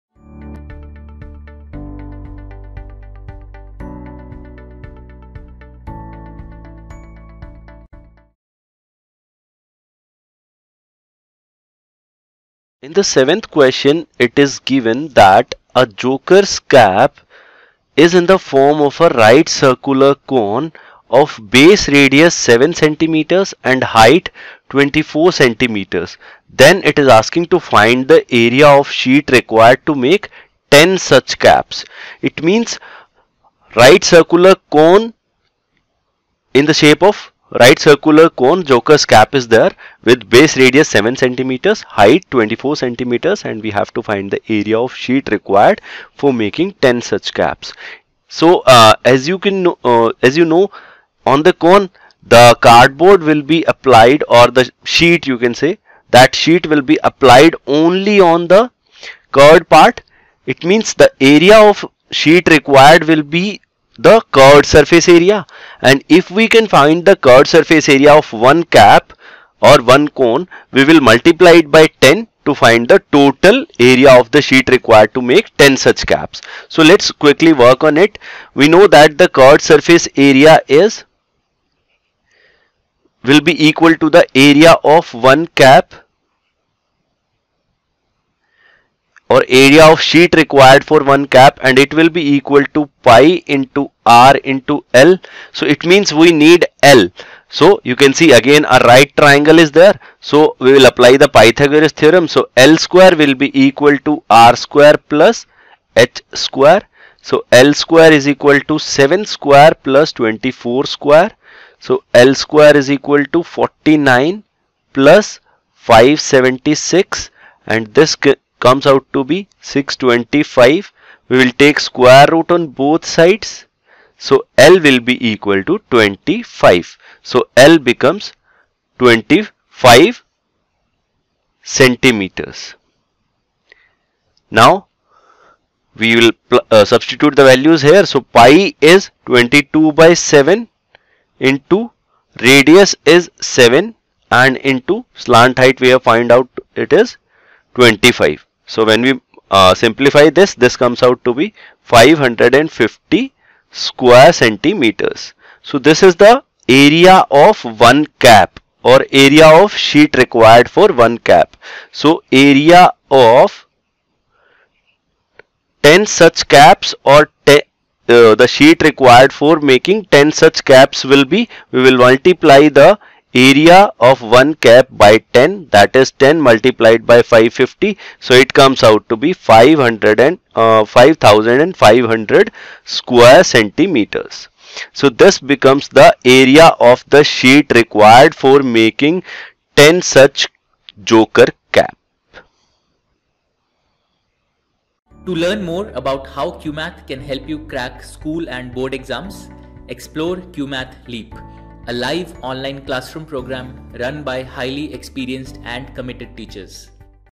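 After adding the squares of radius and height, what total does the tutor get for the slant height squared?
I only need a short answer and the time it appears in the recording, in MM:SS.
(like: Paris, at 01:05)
625, at 01:59.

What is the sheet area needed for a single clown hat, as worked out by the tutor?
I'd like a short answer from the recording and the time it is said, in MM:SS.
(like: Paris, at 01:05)
550 square centimeters, at 02:31.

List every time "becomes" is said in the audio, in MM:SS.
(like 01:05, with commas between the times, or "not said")
02:07, 03:05.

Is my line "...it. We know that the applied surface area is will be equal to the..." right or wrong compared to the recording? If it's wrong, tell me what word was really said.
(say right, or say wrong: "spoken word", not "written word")
wrong: "curved", not "applied".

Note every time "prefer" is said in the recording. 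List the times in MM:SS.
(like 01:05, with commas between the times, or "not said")
not said.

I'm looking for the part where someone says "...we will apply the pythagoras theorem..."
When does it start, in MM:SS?
01:40.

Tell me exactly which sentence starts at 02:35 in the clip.
So this is the area of one cap or area of sheet required for one cap.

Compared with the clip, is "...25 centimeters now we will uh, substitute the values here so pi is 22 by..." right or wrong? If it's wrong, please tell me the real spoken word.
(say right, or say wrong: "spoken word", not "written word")
right.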